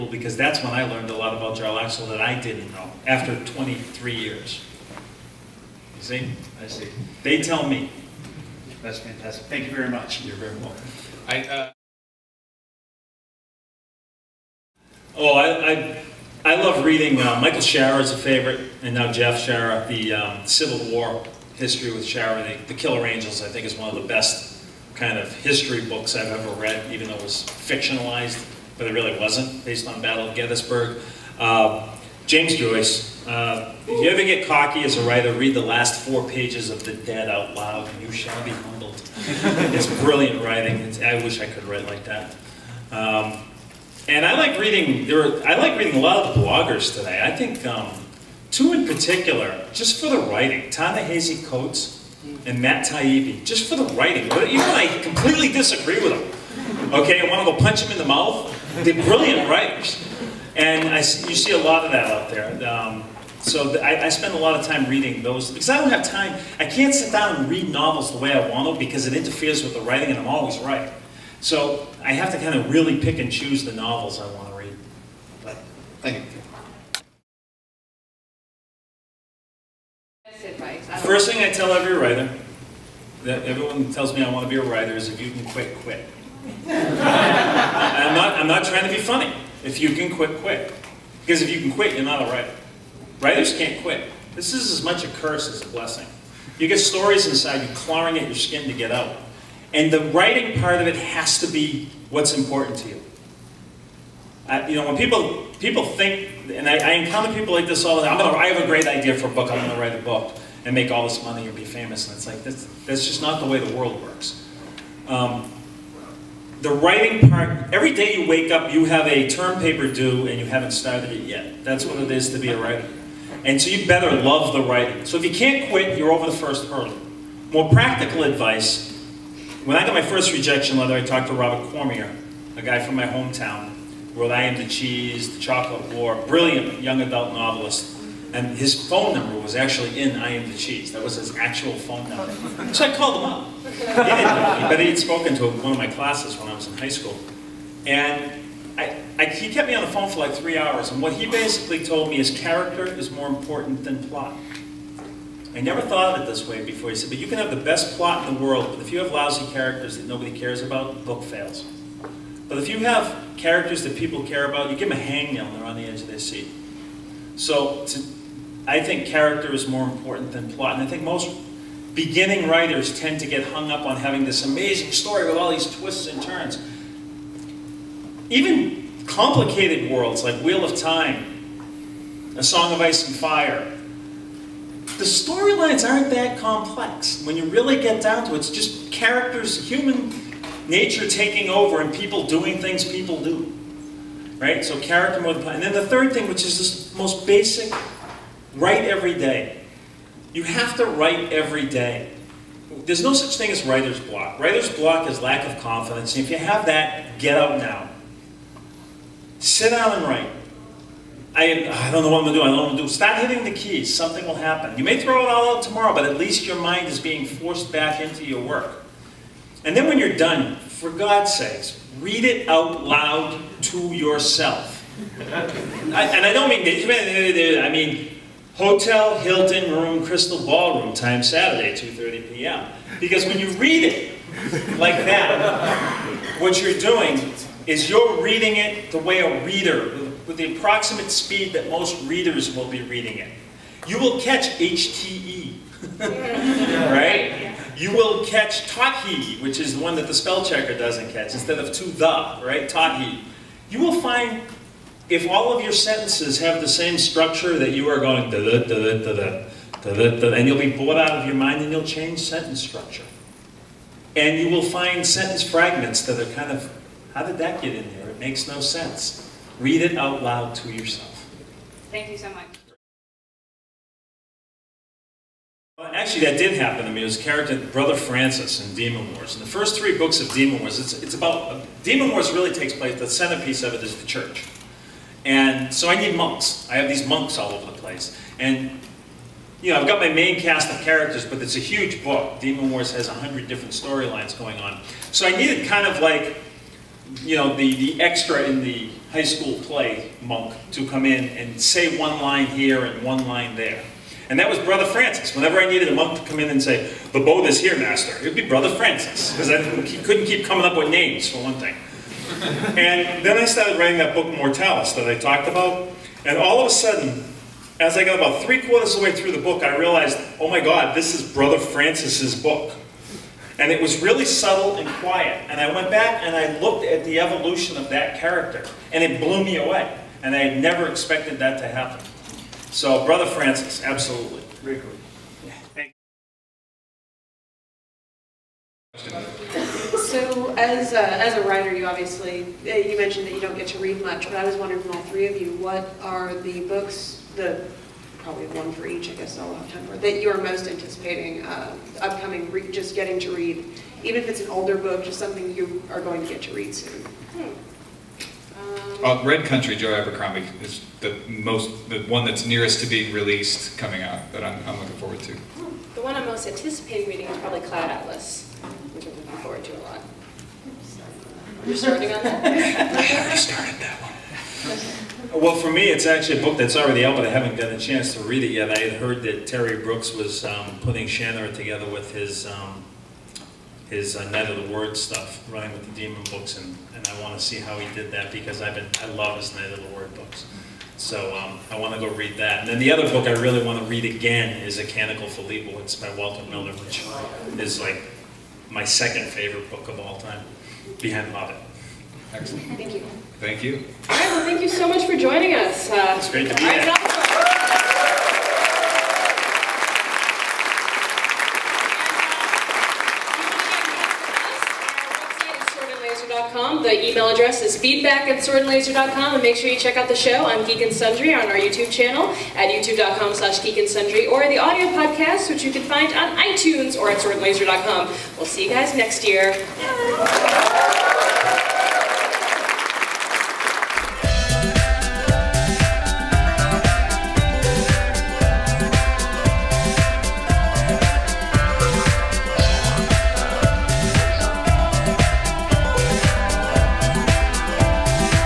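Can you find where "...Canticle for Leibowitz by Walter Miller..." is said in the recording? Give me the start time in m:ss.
6:34.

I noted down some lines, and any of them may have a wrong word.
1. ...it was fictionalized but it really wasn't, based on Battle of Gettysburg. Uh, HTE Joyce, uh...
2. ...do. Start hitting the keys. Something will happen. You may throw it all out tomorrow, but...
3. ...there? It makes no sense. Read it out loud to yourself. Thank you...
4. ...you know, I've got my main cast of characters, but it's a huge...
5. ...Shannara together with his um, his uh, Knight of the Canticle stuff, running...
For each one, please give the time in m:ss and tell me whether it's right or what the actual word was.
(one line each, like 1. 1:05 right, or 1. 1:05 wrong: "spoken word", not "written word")
1. 0:27 wrong: "James", not "HTE"
2. 3:32 right
3. 4:27 right
4. 4:49 right
5. 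6:21 wrong: "Word", not "Canticle".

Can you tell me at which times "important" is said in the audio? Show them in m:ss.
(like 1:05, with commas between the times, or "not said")
1:42, 2:33, 2:49.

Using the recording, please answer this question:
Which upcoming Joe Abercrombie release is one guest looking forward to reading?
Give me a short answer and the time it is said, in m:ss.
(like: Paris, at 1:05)
Red Country, at 5:59.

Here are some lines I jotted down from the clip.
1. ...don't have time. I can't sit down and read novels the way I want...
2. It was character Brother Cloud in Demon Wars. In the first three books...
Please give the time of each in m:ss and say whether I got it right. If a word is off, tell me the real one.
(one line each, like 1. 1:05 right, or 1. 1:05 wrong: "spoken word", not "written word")
1. 1:05 right
2. 4:37 wrong: "Francis", not "Cloud".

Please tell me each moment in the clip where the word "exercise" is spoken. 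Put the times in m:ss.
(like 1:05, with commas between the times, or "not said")
not said.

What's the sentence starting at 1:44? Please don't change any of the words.
you know, when people people think, and I, I, encounter people like this all the time.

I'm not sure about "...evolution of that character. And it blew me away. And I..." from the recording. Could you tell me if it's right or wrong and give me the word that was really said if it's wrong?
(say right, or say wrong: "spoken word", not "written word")
right.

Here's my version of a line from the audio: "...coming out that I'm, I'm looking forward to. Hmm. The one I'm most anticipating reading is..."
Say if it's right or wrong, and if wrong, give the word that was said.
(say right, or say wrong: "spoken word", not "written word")
right.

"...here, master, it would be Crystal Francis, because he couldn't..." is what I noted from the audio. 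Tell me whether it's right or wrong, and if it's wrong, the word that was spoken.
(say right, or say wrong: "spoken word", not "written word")
wrong: "Brother", not "Crystal".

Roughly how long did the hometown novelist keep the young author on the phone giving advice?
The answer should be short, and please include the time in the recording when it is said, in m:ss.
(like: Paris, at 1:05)
3 hours, at 2:30.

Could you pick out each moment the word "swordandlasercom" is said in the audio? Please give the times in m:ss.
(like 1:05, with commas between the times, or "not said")
6:58, 7:07.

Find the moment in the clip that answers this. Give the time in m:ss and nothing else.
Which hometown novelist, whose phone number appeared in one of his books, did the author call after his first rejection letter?
2:11.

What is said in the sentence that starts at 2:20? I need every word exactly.
That was his actual phone number.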